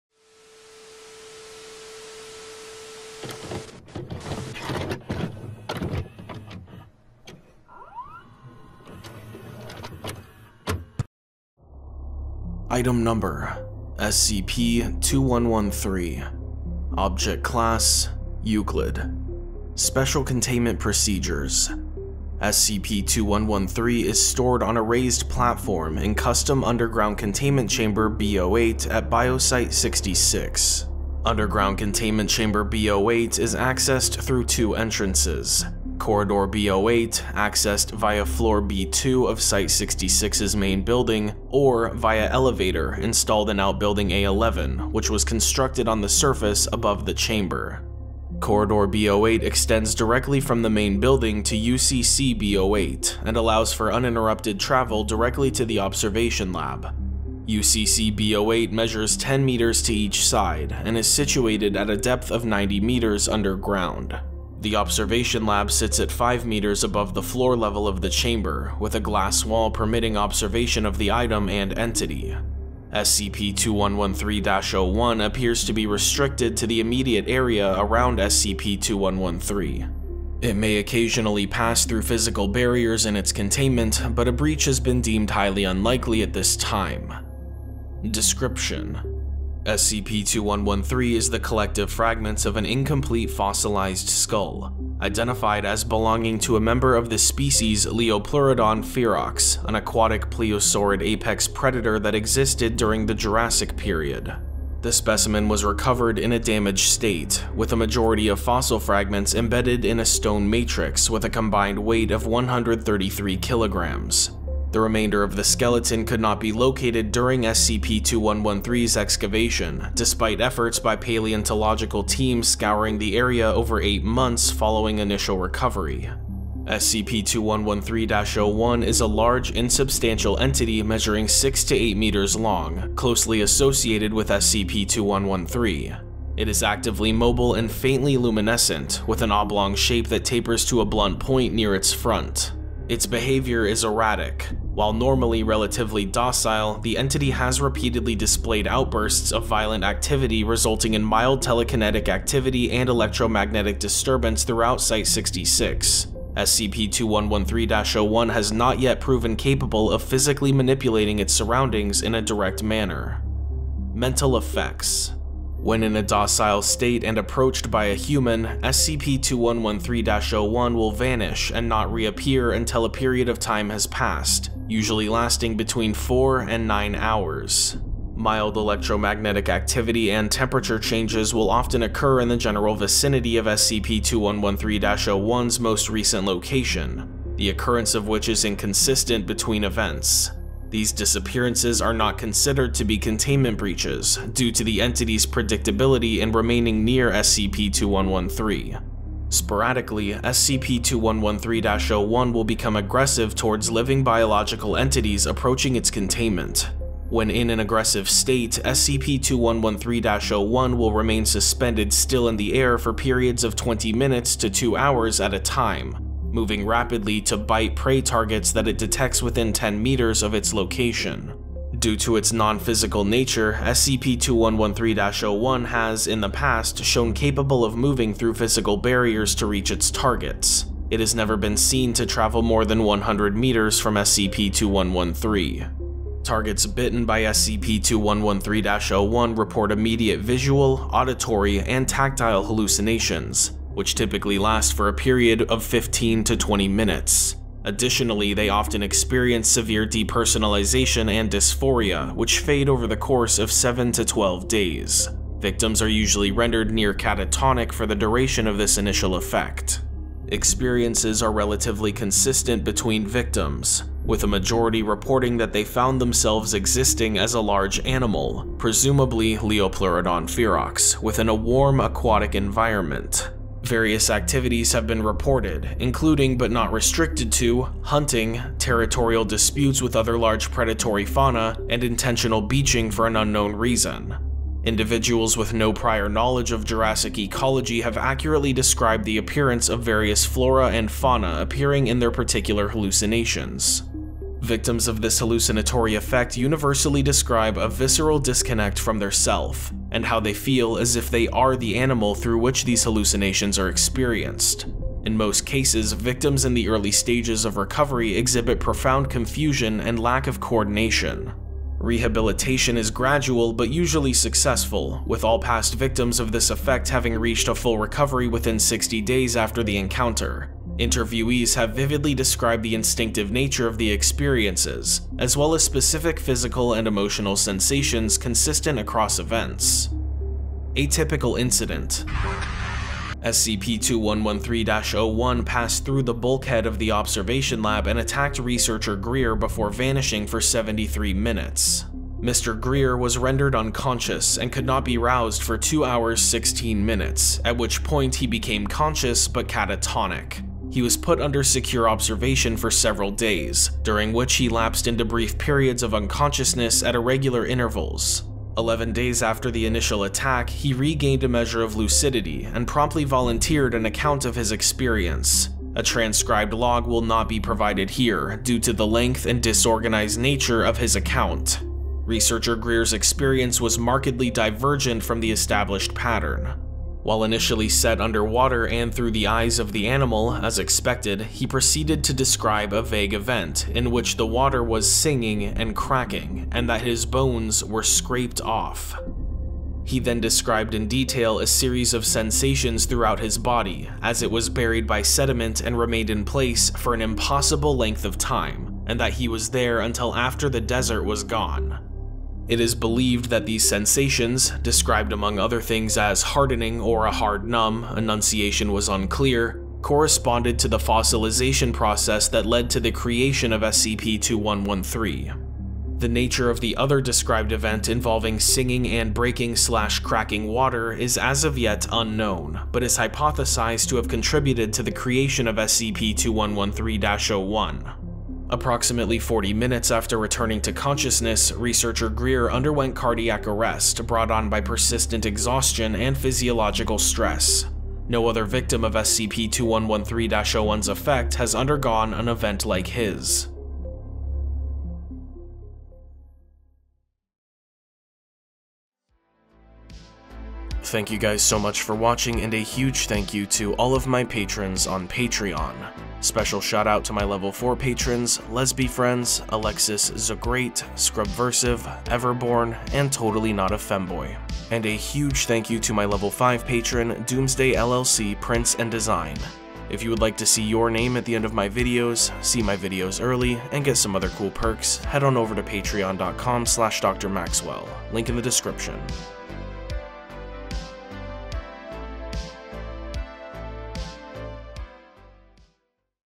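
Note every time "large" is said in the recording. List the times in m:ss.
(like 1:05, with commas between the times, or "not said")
2:09, 4:27, 4:40.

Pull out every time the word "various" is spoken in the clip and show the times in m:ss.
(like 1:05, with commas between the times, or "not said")
4:33, 4:49.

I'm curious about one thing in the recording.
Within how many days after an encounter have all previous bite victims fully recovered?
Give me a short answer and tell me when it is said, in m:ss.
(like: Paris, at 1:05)
60 days, at 5:18.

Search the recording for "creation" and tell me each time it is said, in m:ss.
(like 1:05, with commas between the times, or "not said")
6:52, 7:04.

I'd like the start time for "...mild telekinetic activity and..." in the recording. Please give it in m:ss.
2:31.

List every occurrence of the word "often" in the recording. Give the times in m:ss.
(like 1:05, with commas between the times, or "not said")
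3:01, 4:08.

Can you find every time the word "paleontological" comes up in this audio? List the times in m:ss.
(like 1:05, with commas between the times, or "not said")
2:00.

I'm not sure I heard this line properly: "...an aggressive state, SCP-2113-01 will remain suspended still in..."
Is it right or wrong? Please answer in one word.
right.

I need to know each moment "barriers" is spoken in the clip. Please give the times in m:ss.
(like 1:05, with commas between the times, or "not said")
1:22, 3:48.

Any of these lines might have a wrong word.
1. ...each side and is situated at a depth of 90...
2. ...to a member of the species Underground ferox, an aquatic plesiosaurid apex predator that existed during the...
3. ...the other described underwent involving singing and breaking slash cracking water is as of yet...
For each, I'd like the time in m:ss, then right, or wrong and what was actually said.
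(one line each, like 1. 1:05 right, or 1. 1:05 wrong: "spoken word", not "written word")
1. 0:59 right
2. 1:36 wrong: "Liopleurodon", not "Underground"
3. 6:56 wrong: "event", not "underwent".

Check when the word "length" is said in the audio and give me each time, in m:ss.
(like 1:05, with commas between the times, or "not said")
6:08, 6:37.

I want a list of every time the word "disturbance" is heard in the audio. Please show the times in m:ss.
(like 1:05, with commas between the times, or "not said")
2:33.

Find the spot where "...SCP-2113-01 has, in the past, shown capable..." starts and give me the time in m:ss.
3:43.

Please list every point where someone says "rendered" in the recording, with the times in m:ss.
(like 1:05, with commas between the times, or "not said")
4:16, 5:43.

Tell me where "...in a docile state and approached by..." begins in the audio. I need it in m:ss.
2:45.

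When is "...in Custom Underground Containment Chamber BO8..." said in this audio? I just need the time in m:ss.
0:25.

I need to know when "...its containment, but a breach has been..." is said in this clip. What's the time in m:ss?
1:23.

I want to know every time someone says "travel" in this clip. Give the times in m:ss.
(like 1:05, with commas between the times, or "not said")
0:54, 3:52.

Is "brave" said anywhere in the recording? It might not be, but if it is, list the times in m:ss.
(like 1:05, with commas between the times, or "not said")
not said.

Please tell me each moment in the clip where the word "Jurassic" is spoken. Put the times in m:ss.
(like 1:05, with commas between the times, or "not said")
1:43, 4:46.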